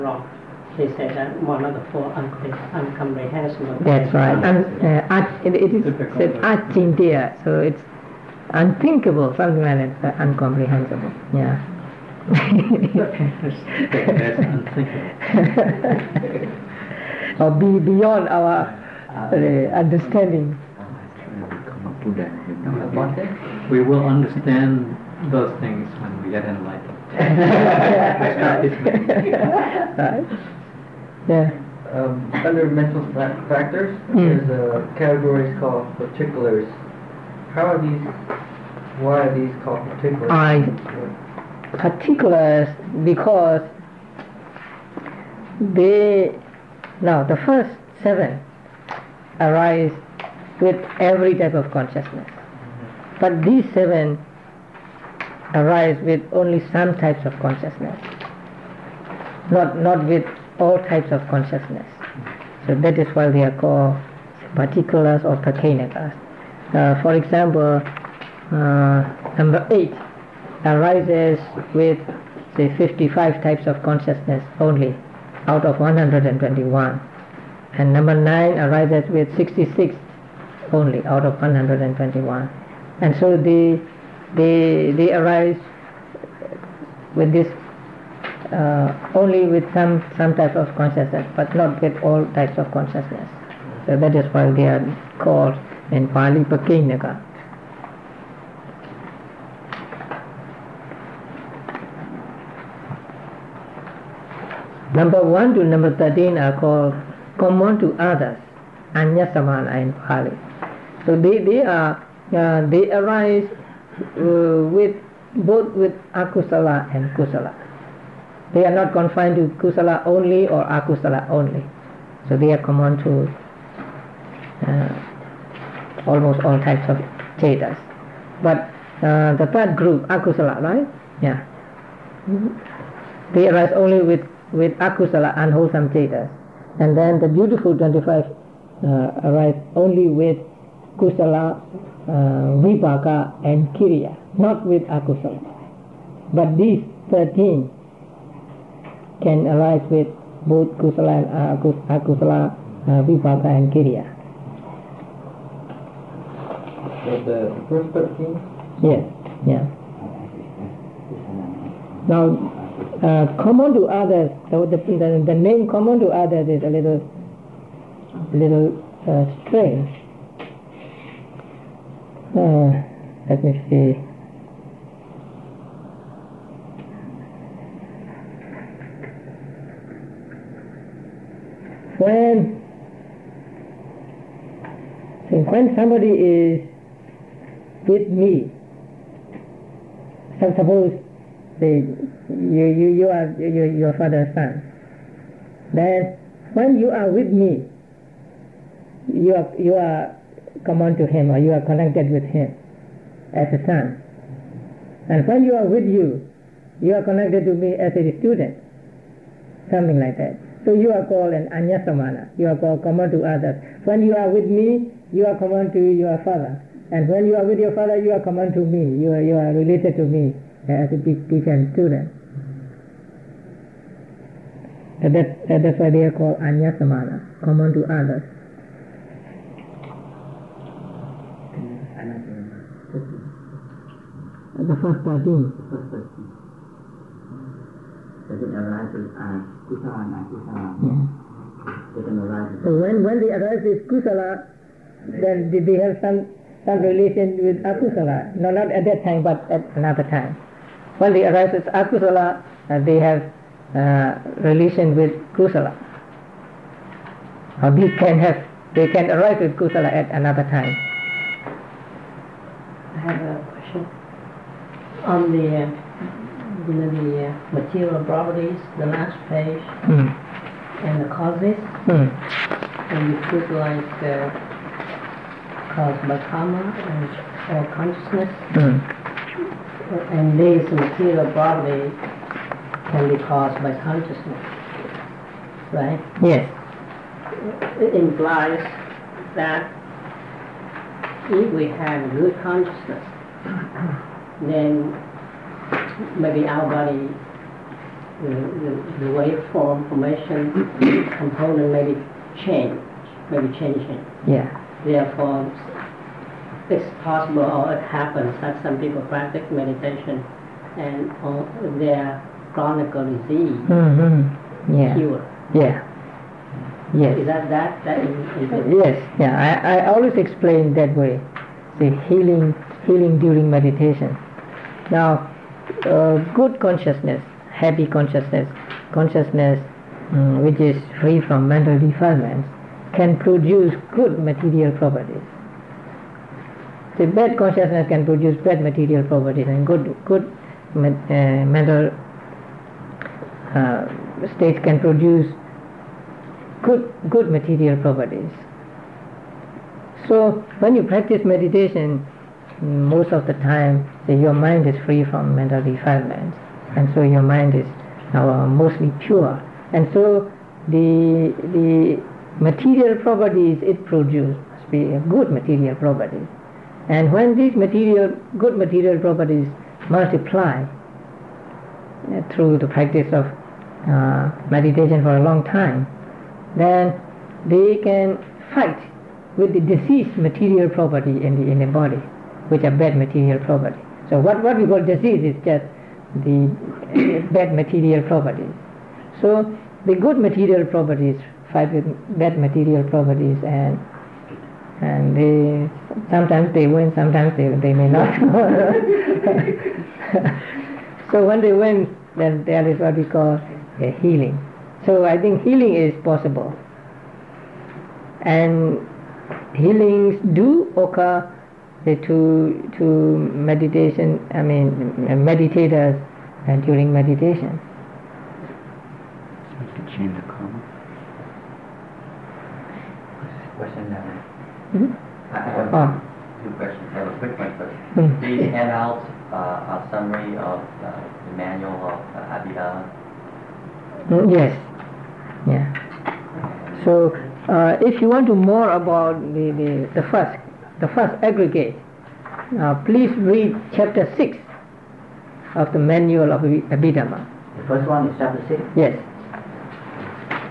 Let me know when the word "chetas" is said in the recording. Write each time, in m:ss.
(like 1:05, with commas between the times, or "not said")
2:07, 2:15.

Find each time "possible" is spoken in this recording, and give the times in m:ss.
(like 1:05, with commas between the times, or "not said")
5:07, 6:46.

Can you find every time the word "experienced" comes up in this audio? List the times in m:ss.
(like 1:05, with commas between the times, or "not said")
not said.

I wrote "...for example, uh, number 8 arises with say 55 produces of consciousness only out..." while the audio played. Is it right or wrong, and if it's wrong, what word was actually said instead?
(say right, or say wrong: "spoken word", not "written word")
wrong: "types", not "produces".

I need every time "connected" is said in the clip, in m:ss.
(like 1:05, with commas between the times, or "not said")
3:21, 3:27.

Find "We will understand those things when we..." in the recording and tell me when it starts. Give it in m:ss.
0:23.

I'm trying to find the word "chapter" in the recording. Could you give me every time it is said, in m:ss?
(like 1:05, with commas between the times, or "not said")
7:23, 7:28.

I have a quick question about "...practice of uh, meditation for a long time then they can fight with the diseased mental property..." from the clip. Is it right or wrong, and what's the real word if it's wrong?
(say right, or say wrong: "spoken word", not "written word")
wrong: "material", not "mental".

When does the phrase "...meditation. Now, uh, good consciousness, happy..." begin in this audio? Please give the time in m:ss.
5:23.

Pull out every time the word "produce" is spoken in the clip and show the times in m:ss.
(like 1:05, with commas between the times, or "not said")
5:33, 5:38, 5:44, 6:03.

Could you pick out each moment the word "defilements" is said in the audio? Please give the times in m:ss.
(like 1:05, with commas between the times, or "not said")
5:31, 5:55.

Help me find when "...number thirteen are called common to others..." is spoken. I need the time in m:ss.
1:45.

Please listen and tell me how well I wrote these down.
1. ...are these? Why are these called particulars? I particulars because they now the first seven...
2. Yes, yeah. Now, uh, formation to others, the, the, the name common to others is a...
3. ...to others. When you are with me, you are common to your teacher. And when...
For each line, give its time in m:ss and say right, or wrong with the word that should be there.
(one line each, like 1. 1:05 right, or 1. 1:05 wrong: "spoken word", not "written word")
1. 0:37 right
2. 2:38 wrong: "common", not "formation"
3. 3:33 wrong: "father", not "teacher".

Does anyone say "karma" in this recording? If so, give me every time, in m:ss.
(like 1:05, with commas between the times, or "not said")
4:36, 7:00.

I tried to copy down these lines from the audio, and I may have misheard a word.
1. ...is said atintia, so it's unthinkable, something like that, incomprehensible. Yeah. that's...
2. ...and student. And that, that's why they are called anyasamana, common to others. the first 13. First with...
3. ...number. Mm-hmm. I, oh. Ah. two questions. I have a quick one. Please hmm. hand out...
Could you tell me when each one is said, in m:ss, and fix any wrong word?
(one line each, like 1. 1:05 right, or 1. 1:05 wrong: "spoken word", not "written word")
1. 0:05 right
2. 3:41 right
3. 7:03 right.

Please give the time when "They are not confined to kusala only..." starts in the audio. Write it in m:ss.
1:58.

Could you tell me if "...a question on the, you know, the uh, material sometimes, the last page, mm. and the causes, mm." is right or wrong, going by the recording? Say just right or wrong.
wrong.